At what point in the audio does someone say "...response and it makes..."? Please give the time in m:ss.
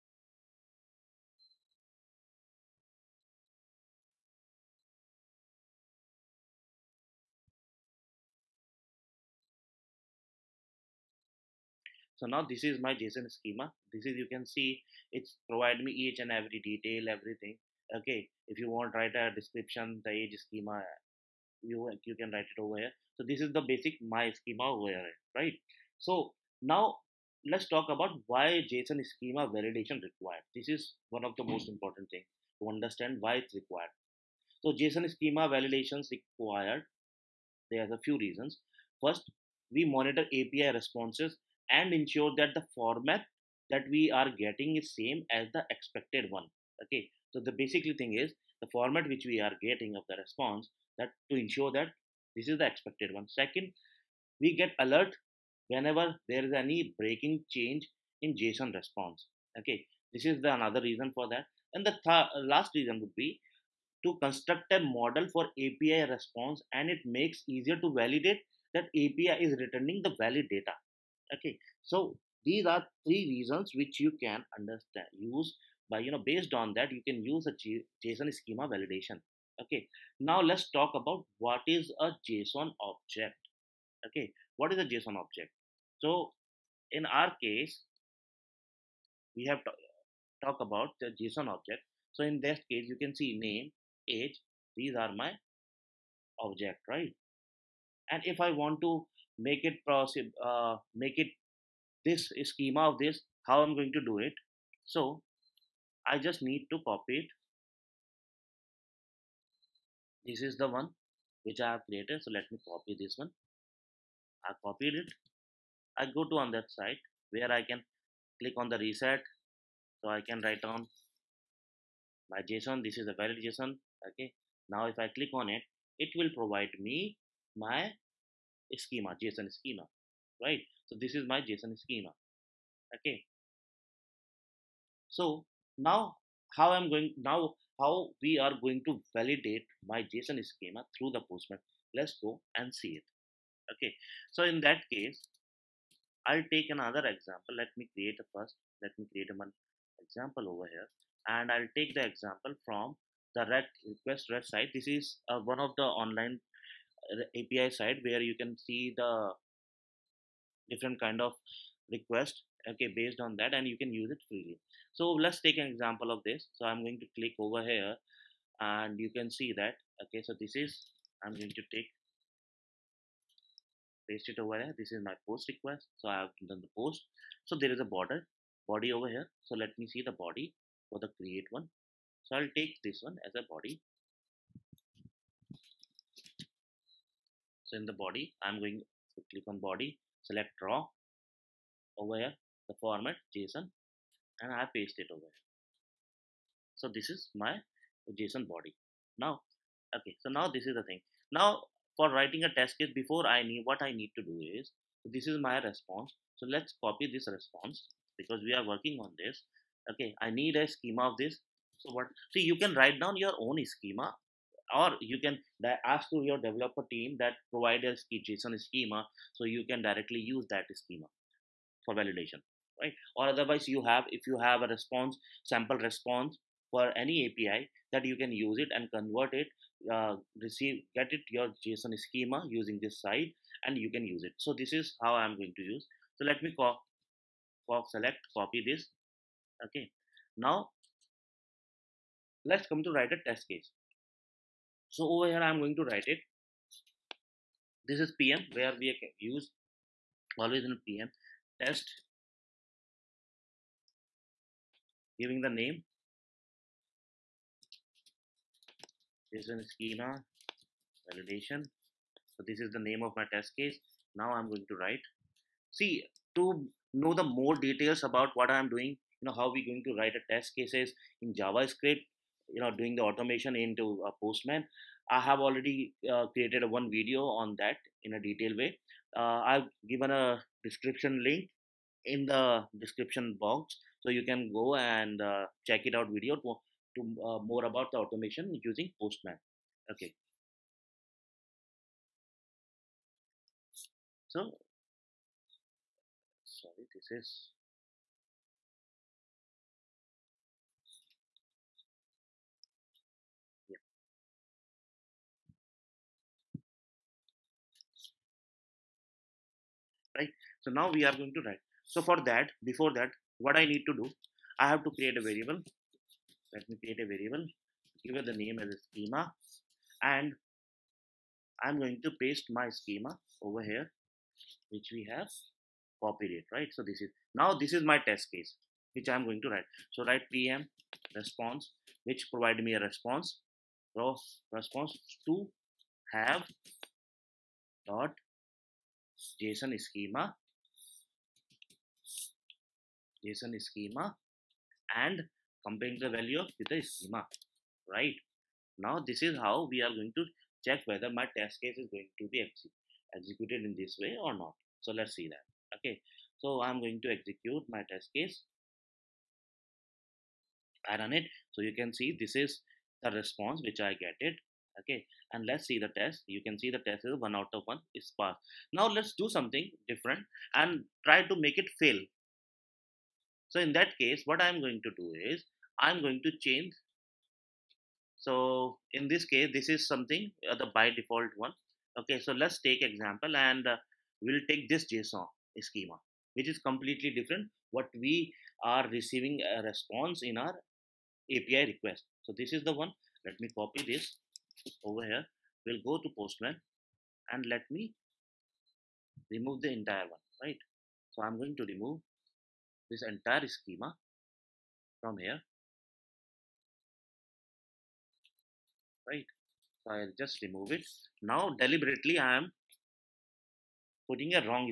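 1:06.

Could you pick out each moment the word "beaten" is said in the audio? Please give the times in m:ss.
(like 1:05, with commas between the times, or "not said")
not said.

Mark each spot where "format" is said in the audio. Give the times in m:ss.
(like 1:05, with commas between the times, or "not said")
0:42, 0:48, 3:12.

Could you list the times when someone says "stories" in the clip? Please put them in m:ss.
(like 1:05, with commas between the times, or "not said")
not said.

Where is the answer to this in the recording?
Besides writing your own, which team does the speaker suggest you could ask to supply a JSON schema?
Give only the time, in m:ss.
3:36.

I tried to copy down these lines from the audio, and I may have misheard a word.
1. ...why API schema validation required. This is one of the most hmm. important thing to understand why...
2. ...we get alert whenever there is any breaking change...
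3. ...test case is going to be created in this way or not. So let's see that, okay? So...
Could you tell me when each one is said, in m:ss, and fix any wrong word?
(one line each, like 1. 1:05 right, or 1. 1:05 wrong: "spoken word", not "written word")
1. 0:28 wrong: "JSON", not "API"
2. 0:54 right
3. 5:51 wrong: "executed", not "created".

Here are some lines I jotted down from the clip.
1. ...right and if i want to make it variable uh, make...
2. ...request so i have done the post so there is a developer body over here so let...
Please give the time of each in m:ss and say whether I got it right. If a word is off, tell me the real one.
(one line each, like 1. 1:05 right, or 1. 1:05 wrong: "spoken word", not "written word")
1. 1:36 wrong: "possible", not "variable"
2. 2:55 wrong: "border", not "developer".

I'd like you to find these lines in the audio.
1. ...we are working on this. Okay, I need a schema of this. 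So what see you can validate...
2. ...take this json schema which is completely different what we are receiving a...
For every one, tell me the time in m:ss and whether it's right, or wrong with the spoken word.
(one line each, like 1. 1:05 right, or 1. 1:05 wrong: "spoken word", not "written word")
1. 3:28 wrong: "write", not "validate"
2. 6:24 right.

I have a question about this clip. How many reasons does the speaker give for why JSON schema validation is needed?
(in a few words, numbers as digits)
3.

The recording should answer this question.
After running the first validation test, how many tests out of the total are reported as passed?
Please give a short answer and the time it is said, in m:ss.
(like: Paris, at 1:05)
1 out of 1, at 6:07.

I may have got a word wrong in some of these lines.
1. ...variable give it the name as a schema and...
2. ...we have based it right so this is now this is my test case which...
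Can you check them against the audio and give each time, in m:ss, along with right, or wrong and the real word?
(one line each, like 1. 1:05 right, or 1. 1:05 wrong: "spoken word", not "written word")
1. 5:17 right
2. 5:24 wrong: "copied", not "based".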